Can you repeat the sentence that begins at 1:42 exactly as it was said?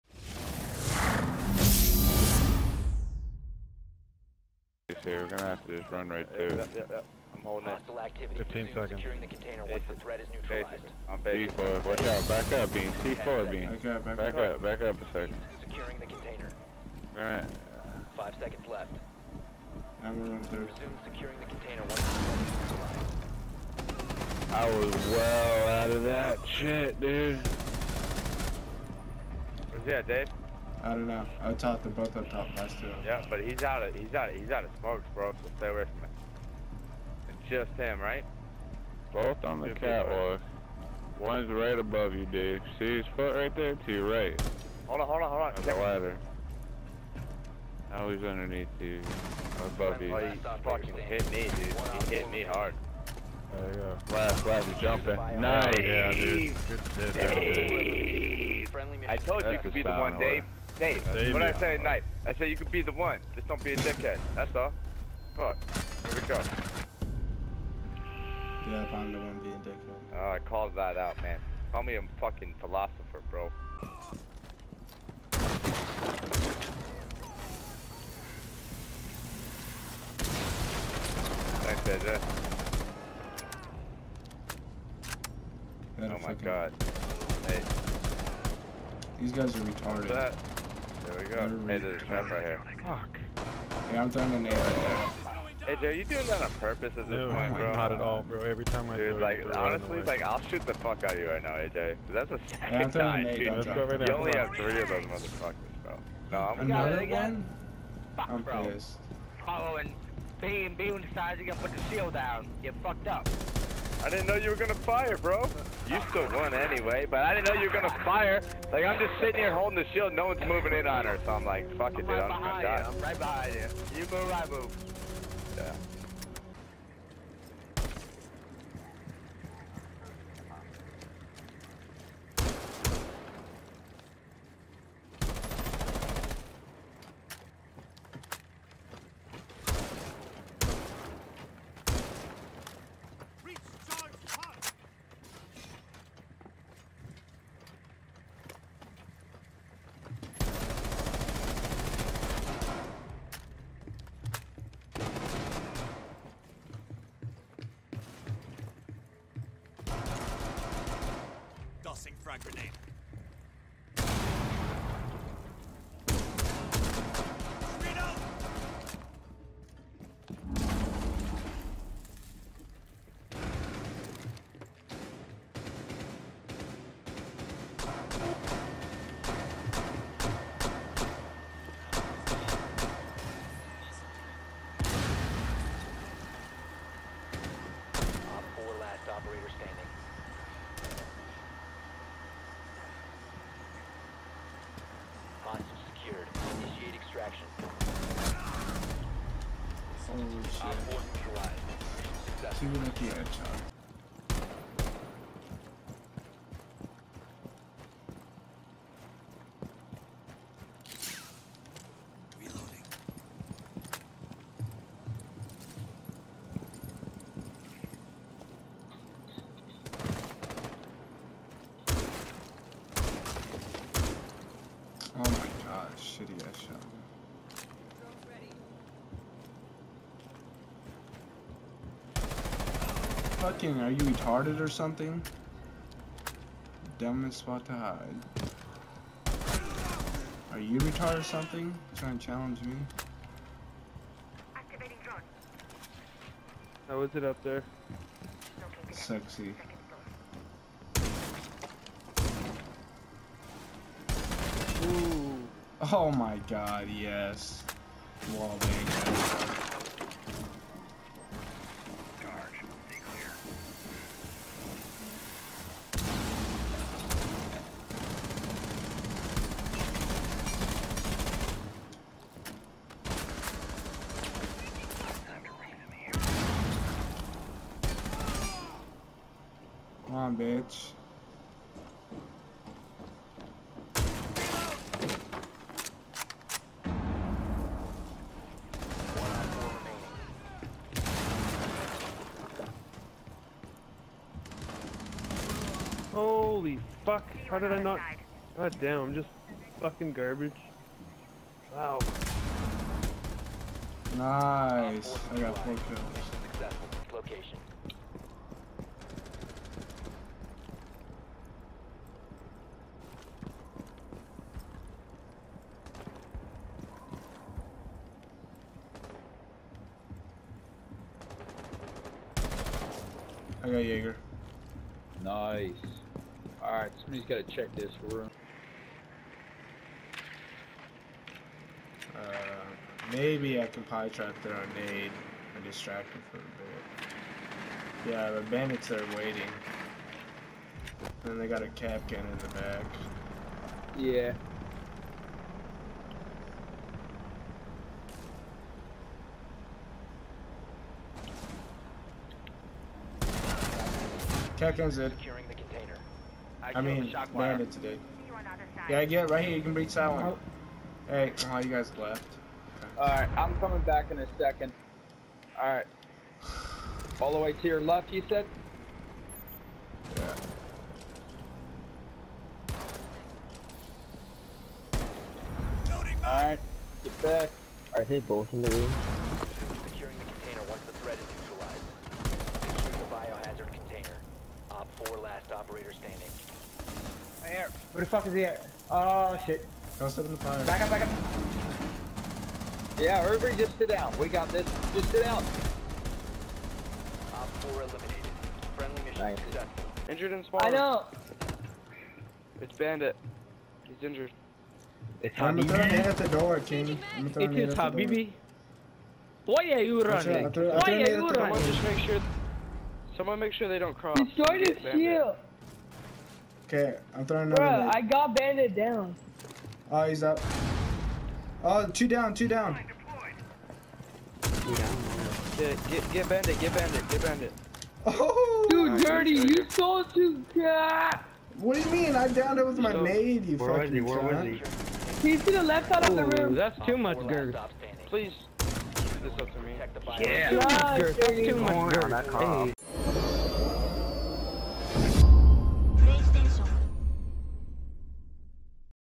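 That's a second yeah, time, dude.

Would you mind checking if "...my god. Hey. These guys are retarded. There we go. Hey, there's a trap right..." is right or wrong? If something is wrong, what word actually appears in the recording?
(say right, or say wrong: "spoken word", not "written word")
right.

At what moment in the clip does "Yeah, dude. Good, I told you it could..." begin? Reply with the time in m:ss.
0:55.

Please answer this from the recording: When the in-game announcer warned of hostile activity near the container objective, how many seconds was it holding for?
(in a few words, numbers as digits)
15 seconds.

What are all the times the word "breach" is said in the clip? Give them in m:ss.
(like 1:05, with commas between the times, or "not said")
5:59.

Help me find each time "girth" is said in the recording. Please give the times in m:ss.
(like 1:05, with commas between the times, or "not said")
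7:17, 7:22.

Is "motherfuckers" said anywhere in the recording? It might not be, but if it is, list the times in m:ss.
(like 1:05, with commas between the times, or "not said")
1:45.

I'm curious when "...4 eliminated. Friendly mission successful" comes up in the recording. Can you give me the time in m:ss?
6:37.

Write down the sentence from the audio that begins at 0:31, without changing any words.
I thought They're both up top.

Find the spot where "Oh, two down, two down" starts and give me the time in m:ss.
7:01.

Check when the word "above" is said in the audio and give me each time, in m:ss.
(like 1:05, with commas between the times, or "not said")
0:41, 0:49.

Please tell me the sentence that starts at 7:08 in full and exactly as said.
Oh, dude, right, dirty, you you told you cat.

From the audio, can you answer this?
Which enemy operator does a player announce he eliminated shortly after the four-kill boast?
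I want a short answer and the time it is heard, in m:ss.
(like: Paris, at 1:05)
Jaeger, at 5:23.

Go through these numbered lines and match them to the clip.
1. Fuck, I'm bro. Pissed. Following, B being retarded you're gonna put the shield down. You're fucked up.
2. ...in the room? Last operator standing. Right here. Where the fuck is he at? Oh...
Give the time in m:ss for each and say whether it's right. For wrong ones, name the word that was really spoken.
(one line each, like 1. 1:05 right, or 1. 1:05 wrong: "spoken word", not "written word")
1. 1:48 wrong: "decided", not "retarded"
2. 6:18 right.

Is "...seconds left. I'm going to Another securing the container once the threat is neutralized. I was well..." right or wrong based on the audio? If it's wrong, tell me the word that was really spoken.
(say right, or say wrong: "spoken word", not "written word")
wrong: "Resume", not "Another".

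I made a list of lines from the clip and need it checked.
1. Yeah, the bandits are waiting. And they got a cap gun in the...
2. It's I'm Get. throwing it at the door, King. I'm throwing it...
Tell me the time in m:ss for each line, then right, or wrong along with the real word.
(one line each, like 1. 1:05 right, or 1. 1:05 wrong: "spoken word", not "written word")
1. 5:38 right
2. 6:45 wrong: "Habibi", not "Get".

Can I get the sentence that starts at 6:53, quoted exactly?
Someone make sure they don't cross.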